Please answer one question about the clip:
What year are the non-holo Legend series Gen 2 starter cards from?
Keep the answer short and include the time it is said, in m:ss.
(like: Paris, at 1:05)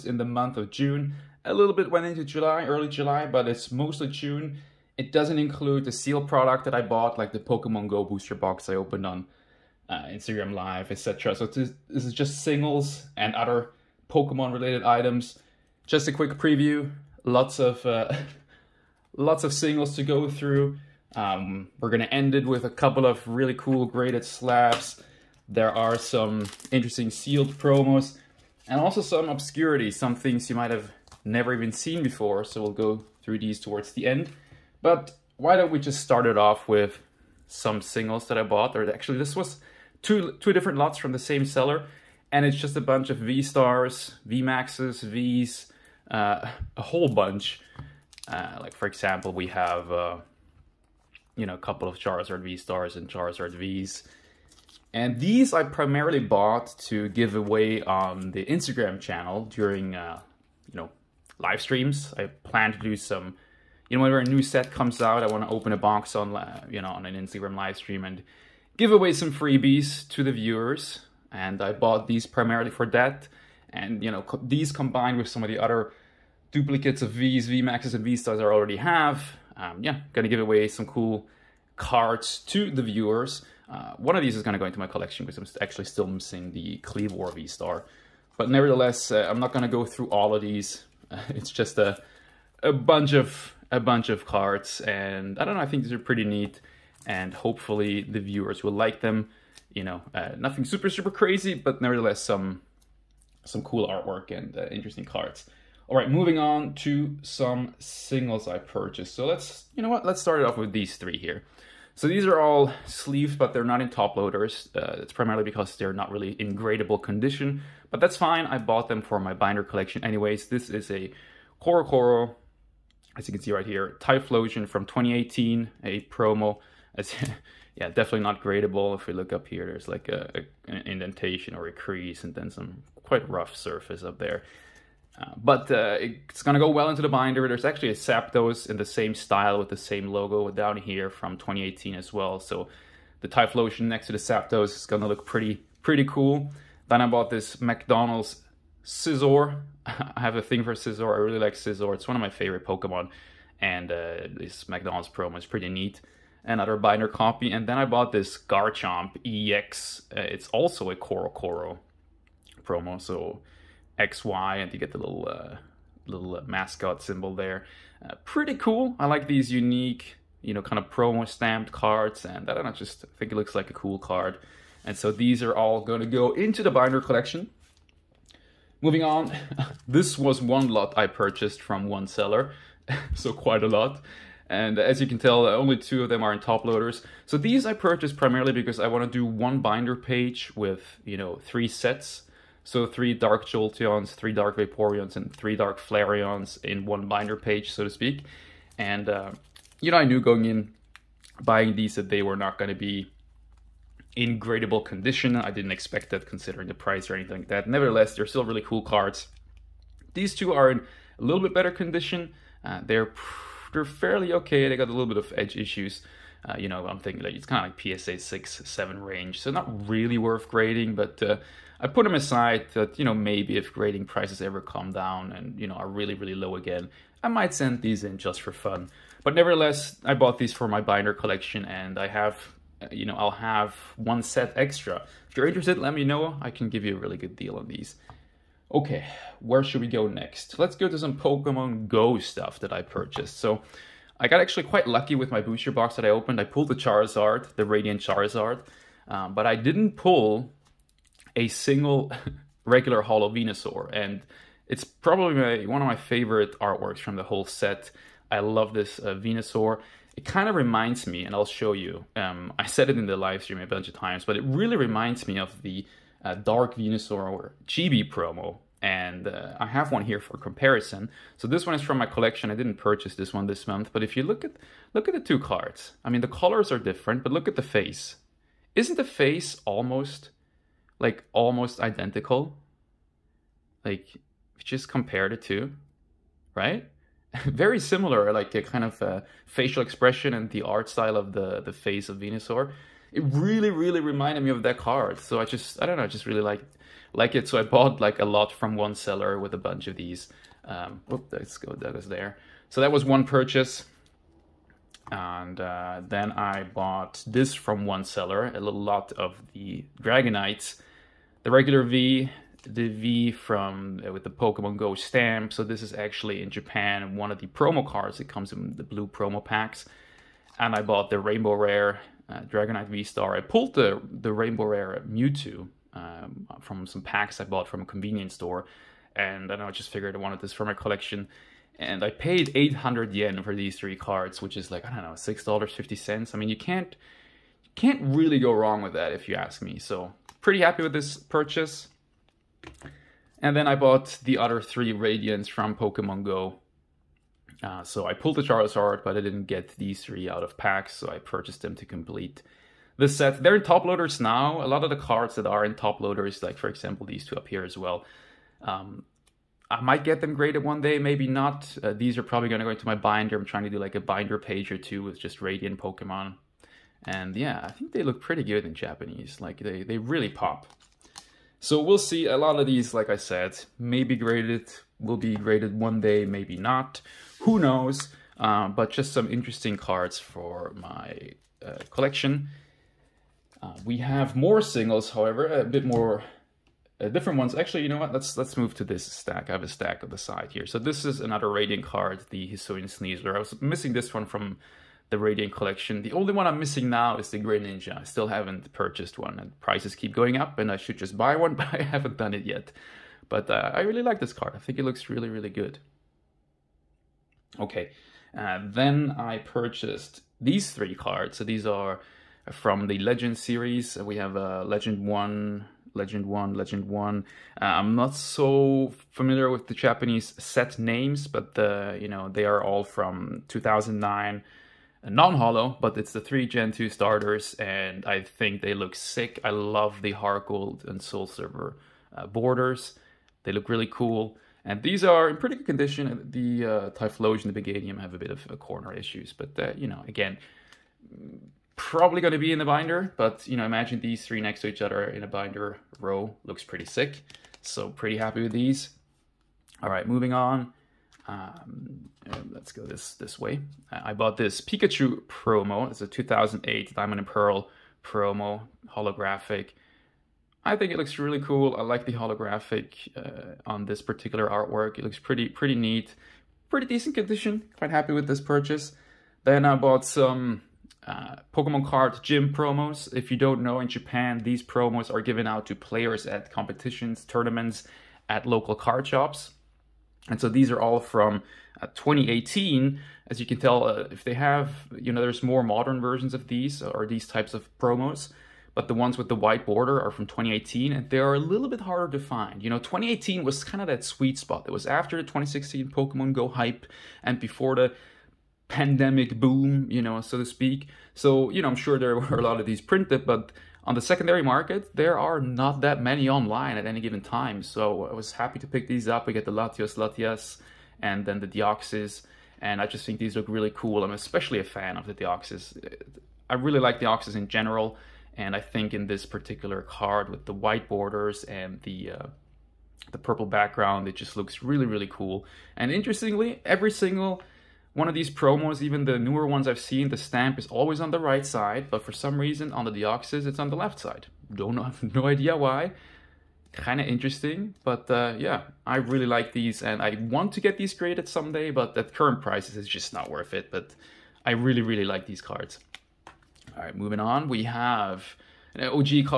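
2009, at 7:03.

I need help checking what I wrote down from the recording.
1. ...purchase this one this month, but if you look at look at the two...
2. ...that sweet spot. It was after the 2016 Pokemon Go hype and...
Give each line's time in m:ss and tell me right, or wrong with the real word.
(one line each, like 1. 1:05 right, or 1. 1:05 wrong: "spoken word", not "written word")
1. 4:32 right
2. 8:13 right.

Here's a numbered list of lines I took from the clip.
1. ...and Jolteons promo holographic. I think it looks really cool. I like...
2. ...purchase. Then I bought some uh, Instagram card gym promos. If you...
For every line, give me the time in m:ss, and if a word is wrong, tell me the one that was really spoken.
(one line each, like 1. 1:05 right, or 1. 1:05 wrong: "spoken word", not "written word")
1. 7:37 wrong: "Pearl", not "Jolteons"
2. 7:48 wrong: "Pokemon", not "Instagram".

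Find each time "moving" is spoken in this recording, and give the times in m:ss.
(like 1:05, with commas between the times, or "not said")
1:46, 2:58, 7:30, 9:06.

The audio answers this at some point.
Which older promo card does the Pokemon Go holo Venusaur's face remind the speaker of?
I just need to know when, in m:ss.
4:26.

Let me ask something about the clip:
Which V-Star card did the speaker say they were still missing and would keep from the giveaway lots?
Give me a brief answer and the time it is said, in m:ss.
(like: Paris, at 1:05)
Kleavor V-Star, at 1:26.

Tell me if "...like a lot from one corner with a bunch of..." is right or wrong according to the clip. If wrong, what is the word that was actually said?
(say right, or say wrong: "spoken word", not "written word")
wrong: "seller", not "corner".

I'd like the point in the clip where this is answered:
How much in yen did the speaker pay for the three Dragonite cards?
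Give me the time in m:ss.
5:32.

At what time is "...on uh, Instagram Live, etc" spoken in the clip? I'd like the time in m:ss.
0:09.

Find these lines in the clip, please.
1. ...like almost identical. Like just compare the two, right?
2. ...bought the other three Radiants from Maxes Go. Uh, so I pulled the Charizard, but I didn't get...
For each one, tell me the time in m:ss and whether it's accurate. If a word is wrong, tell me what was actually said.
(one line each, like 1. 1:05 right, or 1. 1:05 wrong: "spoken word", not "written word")
1. 4:41 right
2. 5:43 wrong: "Pokemon", not "Maxes".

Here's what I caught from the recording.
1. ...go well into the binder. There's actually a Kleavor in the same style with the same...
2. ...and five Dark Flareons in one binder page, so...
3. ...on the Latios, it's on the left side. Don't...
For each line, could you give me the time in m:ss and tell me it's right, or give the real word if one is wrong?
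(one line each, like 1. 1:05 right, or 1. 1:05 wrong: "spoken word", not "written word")
1. 2:16 wrong: "Zapdos", not "Kleavor"
2. 3:15 wrong: "three", not "five"
3. 8:52 wrong: "Deoxys", not "Latios".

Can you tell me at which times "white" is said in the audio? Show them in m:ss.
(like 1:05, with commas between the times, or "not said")
8:09, 8:40.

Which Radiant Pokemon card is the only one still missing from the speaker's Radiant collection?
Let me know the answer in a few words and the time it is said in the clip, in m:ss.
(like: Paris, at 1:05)
Greninja, at 6:37.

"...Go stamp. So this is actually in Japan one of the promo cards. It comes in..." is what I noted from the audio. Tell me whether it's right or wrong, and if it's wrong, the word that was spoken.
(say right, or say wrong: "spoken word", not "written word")
right.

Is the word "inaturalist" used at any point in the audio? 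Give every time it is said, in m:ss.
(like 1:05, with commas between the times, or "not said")
not said.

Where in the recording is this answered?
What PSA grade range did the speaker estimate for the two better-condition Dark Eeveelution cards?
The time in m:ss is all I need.
3:37.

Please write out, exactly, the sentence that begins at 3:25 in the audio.
I didn't expect that considering the price or anything like that.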